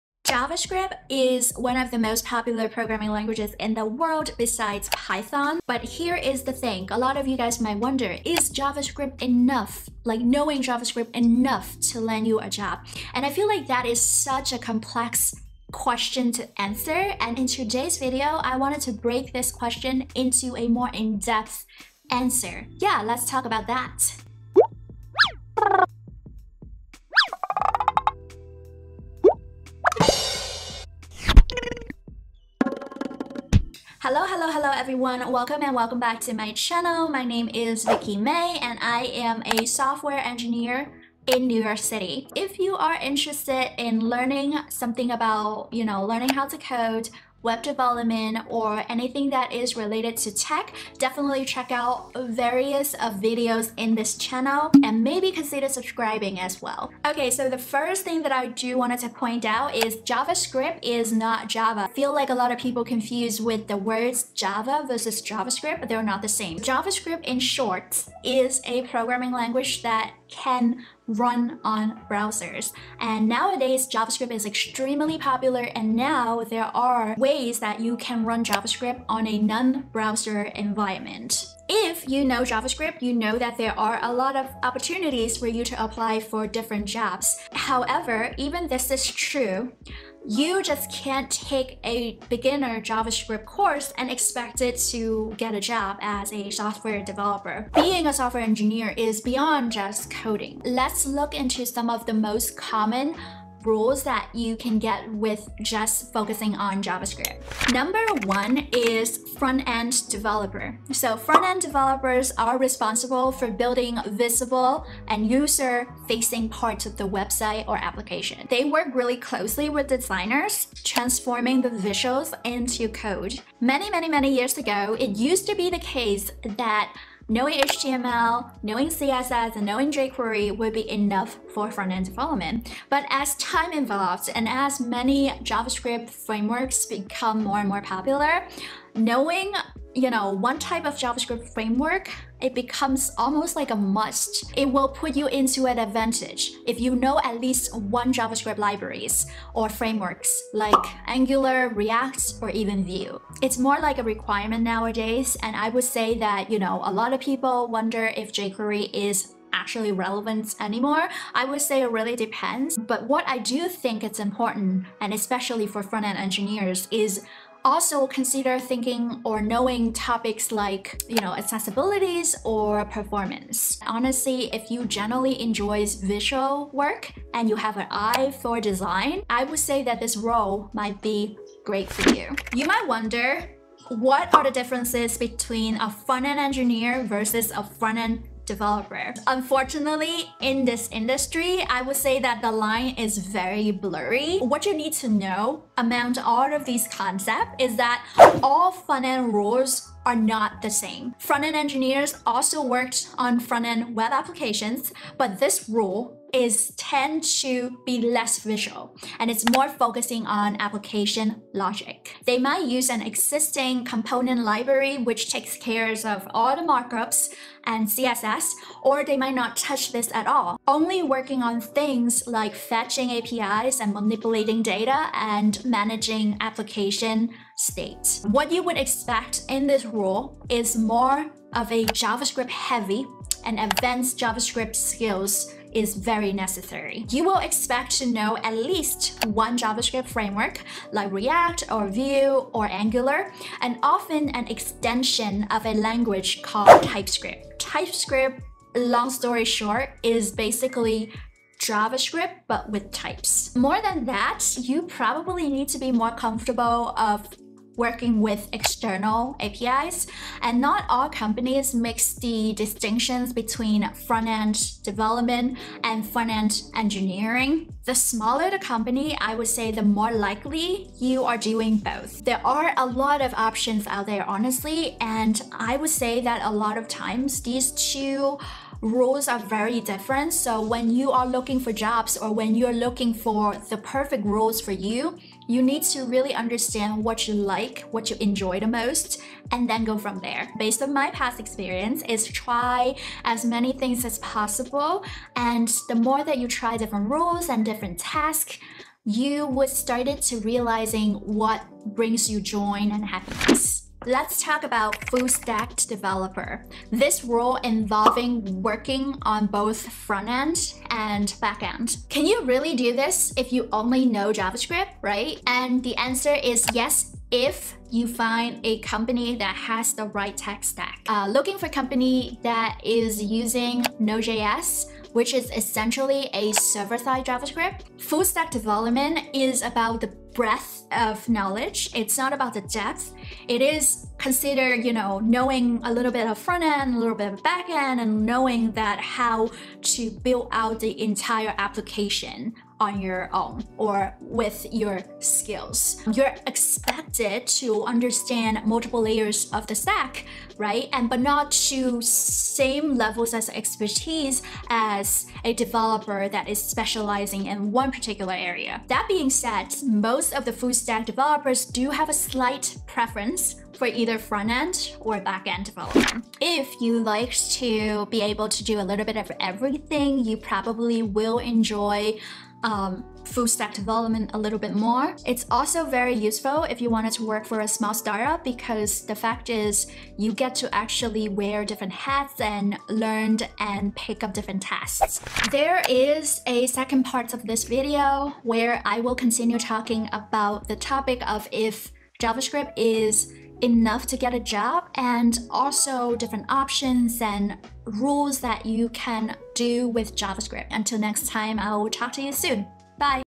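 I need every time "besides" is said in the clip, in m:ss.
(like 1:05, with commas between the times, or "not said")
0:04.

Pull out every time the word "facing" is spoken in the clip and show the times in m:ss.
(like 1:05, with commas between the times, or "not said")
1:55.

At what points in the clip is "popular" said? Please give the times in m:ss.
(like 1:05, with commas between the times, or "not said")
0:02, 1:15, 2:17.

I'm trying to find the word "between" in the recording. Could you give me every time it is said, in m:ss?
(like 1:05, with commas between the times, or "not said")
3:05, 4:23.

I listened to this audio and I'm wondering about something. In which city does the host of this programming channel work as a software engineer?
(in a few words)
New York City.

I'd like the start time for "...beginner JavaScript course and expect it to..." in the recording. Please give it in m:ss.
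1:32.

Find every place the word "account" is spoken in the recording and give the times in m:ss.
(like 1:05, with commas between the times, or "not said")
not said.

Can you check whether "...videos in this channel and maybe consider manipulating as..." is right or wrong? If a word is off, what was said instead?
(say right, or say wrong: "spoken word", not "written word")
wrong: "subscribing", not "manipulating".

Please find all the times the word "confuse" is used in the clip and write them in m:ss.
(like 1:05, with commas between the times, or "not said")
1:02.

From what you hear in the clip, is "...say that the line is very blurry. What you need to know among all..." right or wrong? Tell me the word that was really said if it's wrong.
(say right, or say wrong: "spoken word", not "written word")
right.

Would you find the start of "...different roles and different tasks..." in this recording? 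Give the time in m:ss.
4:56.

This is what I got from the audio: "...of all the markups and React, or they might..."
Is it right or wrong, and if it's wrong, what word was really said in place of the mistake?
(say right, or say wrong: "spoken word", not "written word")
wrong: "CSS", not "React".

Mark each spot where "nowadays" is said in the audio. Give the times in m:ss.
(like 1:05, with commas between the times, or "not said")
1:13, 2:34.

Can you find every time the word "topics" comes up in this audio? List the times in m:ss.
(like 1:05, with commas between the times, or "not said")
2:49, 6:30.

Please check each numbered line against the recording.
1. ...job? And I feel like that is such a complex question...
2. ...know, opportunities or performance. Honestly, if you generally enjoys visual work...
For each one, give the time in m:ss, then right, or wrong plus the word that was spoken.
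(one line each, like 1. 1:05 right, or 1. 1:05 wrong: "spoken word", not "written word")
1. 0:12 right
2. 2:51 wrong: "accessibilities", not "opportunities".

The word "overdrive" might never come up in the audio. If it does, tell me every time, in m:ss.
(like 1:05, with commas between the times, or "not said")
not said.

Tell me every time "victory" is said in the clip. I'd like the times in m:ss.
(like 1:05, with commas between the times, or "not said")
not said.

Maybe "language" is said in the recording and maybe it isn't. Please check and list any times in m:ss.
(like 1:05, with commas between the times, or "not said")
0:03, 1:09, 4:05.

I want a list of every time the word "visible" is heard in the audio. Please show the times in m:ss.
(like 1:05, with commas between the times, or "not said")
1:54.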